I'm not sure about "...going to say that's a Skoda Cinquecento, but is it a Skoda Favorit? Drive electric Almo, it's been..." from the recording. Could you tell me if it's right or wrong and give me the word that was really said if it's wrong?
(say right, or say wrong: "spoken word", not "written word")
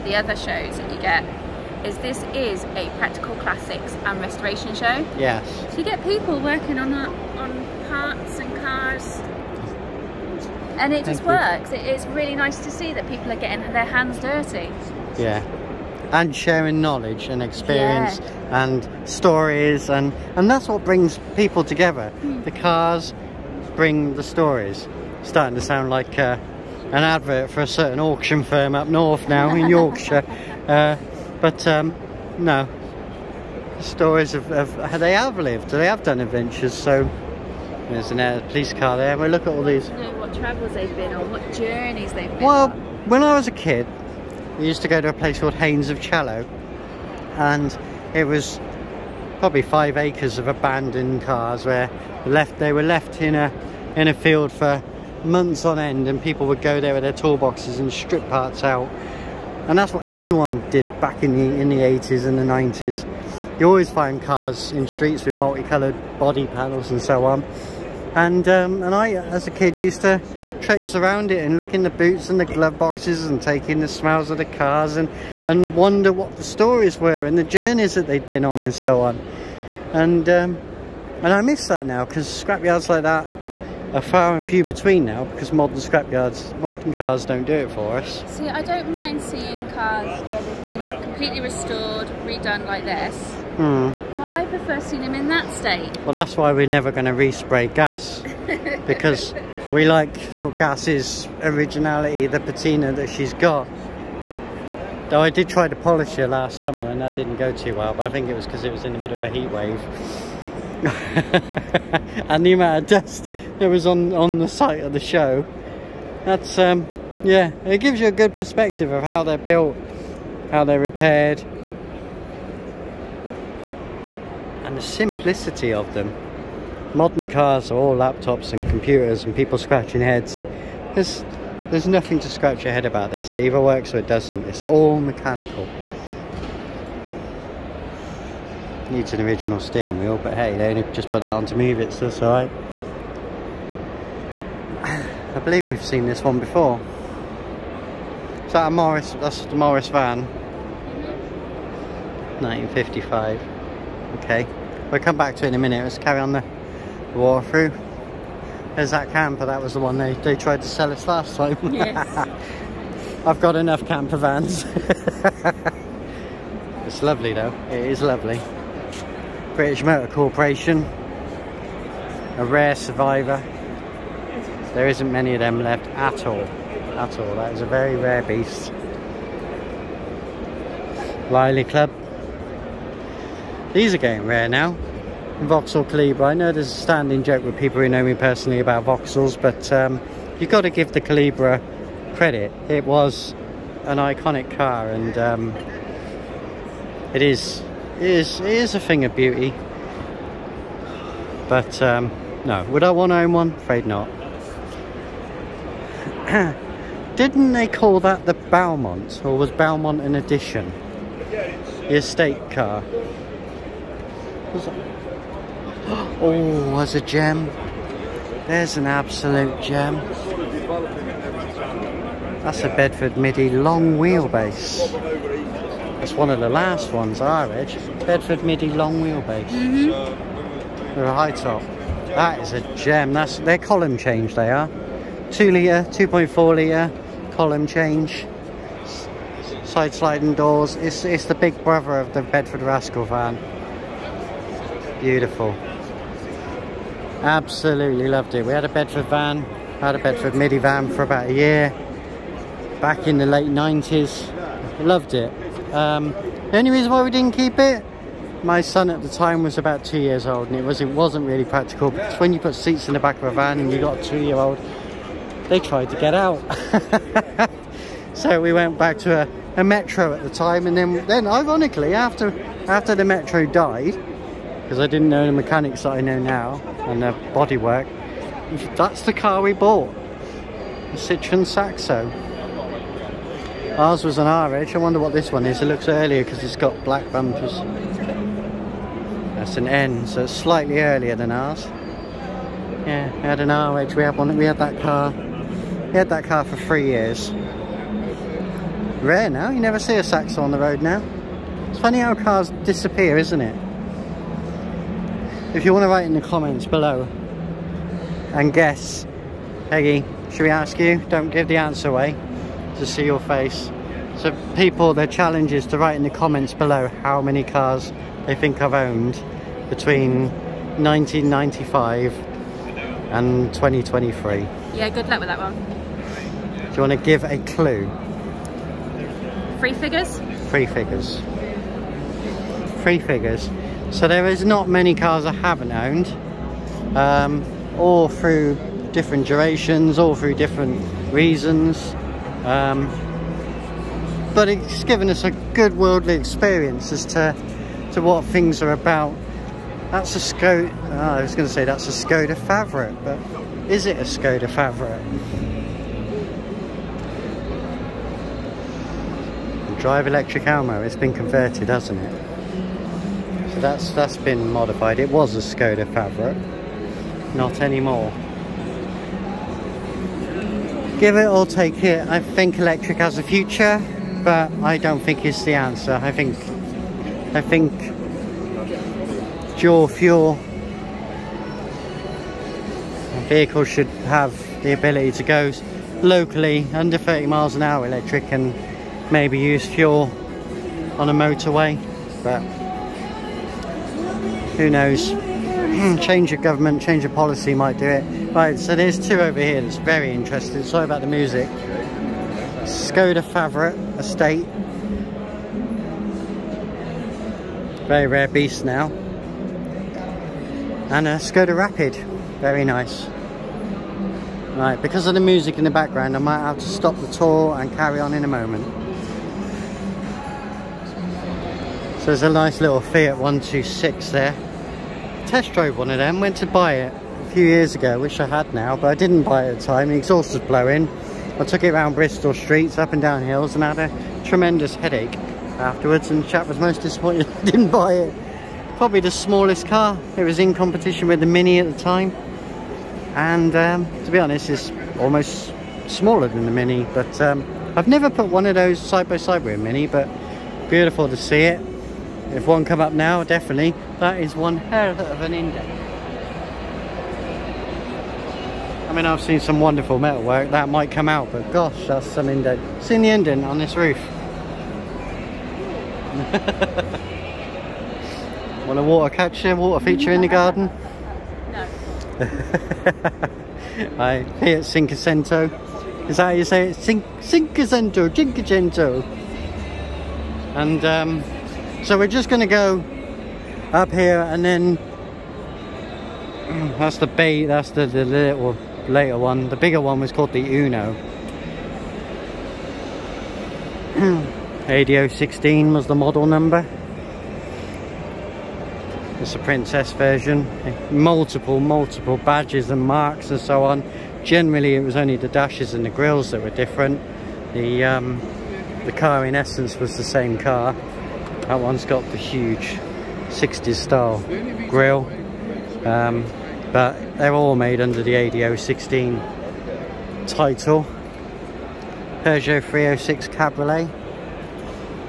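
wrong: "Favorit", not "Cinquecento".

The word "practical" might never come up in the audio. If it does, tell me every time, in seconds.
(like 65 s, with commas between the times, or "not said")
2 s, 261 s.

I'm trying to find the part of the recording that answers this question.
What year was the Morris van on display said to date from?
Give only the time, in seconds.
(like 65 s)
152 s.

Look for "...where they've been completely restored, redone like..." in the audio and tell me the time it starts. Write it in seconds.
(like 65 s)
90 s.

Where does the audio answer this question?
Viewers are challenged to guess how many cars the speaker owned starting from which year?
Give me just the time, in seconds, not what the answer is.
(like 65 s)
320 s.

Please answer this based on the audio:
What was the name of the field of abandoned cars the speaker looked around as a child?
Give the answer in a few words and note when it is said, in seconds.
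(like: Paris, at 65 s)
Haynes of Cello, at 45 s.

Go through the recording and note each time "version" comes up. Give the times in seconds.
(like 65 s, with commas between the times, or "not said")
499 s.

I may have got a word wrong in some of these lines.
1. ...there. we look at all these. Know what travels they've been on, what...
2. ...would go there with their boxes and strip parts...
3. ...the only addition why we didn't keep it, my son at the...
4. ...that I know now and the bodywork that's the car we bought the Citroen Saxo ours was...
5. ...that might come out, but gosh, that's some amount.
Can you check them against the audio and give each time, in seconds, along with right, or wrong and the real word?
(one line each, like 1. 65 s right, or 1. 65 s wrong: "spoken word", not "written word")
1. 38 s right
2. 56 s wrong: "toolboxes", not "boxes"
3. 256 s wrong: "reason", not "addition"
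4. 275 s right
5. 460 s wrong: "indent", not "amount".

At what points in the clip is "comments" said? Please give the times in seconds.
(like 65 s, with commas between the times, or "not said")
306 s, 316 s.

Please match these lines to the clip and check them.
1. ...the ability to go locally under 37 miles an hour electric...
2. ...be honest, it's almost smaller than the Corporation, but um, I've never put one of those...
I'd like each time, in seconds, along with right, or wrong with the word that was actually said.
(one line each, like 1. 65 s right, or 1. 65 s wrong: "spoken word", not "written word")
1. 384 s wrong: "30", not "37"
2. 444 s wrong: "Mini", not "Corporation".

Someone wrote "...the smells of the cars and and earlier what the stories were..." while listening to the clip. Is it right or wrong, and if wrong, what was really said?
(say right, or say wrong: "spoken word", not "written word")
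wrong: "wonder", not "earlier".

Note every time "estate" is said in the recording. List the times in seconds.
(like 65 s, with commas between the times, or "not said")
211 s, 403 s.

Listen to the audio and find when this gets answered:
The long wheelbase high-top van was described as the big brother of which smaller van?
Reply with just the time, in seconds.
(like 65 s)
242 s.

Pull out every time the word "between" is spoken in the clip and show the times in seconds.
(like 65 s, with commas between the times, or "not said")
84 s, 319 s.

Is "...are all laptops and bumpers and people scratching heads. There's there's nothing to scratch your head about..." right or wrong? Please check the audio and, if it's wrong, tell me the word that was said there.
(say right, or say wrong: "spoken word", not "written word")
wrong: "computers", not "bumpers".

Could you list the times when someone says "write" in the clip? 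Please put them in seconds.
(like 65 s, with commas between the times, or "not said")
305 s, 315 s.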